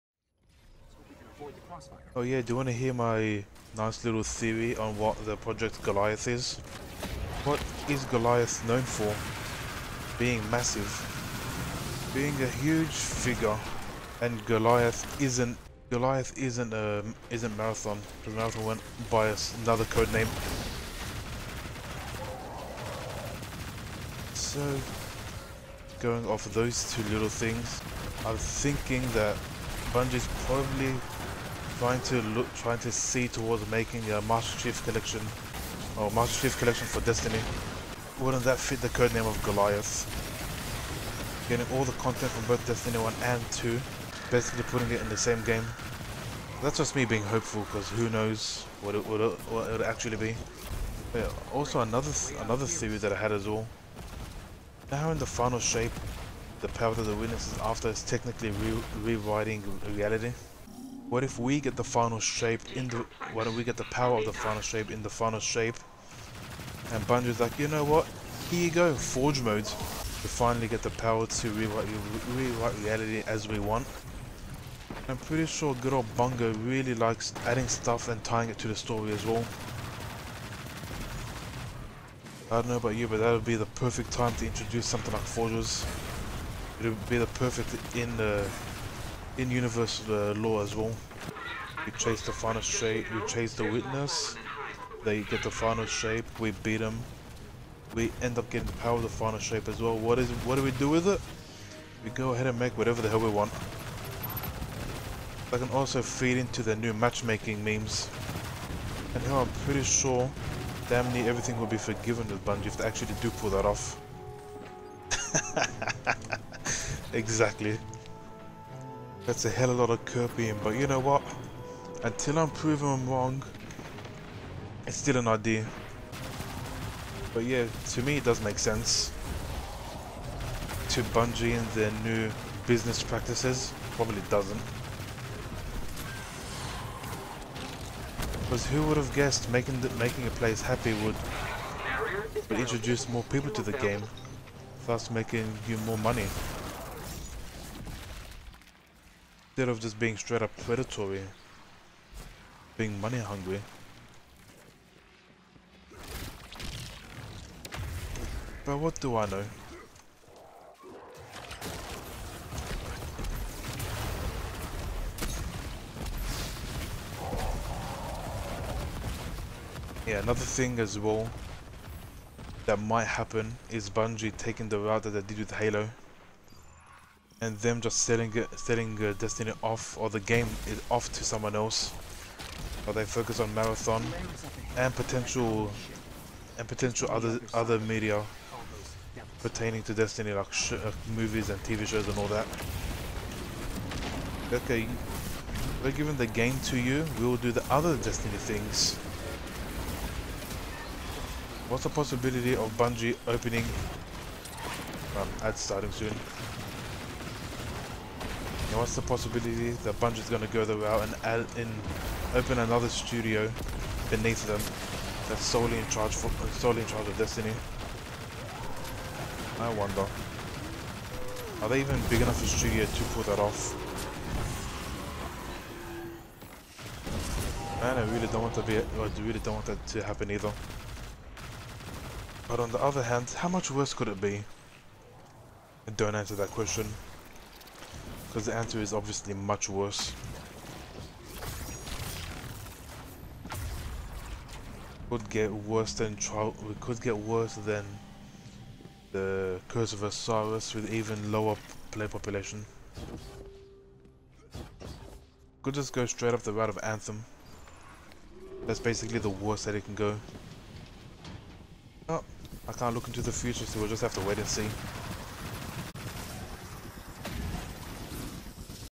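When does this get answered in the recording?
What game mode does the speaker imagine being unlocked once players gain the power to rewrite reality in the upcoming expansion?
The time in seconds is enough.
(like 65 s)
68 s.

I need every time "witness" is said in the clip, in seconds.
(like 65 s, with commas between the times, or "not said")
57 s, 93 s.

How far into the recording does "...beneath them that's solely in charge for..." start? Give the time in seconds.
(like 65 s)
214 s.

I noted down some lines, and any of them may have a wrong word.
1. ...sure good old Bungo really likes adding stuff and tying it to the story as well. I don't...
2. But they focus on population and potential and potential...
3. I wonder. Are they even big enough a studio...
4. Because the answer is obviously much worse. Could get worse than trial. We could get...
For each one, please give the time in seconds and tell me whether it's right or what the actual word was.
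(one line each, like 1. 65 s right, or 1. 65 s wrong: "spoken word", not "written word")
1. 75 s right
2. 182 s wrong: "marathon", not "population"
3. 219 s right
4. 238 s right.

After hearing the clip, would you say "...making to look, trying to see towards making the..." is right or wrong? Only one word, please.
wrong.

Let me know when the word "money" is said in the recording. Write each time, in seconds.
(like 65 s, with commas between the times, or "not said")
145 s, 153 s.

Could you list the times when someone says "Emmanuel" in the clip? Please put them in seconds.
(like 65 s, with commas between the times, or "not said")
not said.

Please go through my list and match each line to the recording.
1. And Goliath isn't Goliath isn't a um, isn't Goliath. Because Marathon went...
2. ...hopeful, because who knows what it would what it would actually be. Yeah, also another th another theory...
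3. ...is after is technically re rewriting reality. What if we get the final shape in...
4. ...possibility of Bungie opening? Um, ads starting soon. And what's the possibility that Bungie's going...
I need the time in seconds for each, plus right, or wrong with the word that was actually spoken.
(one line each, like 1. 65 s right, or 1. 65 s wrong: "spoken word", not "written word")
1. 14 s wrong: "Marathon", not "Goliath"
2. 47 s right
3. 57 s right
4. 201 s right.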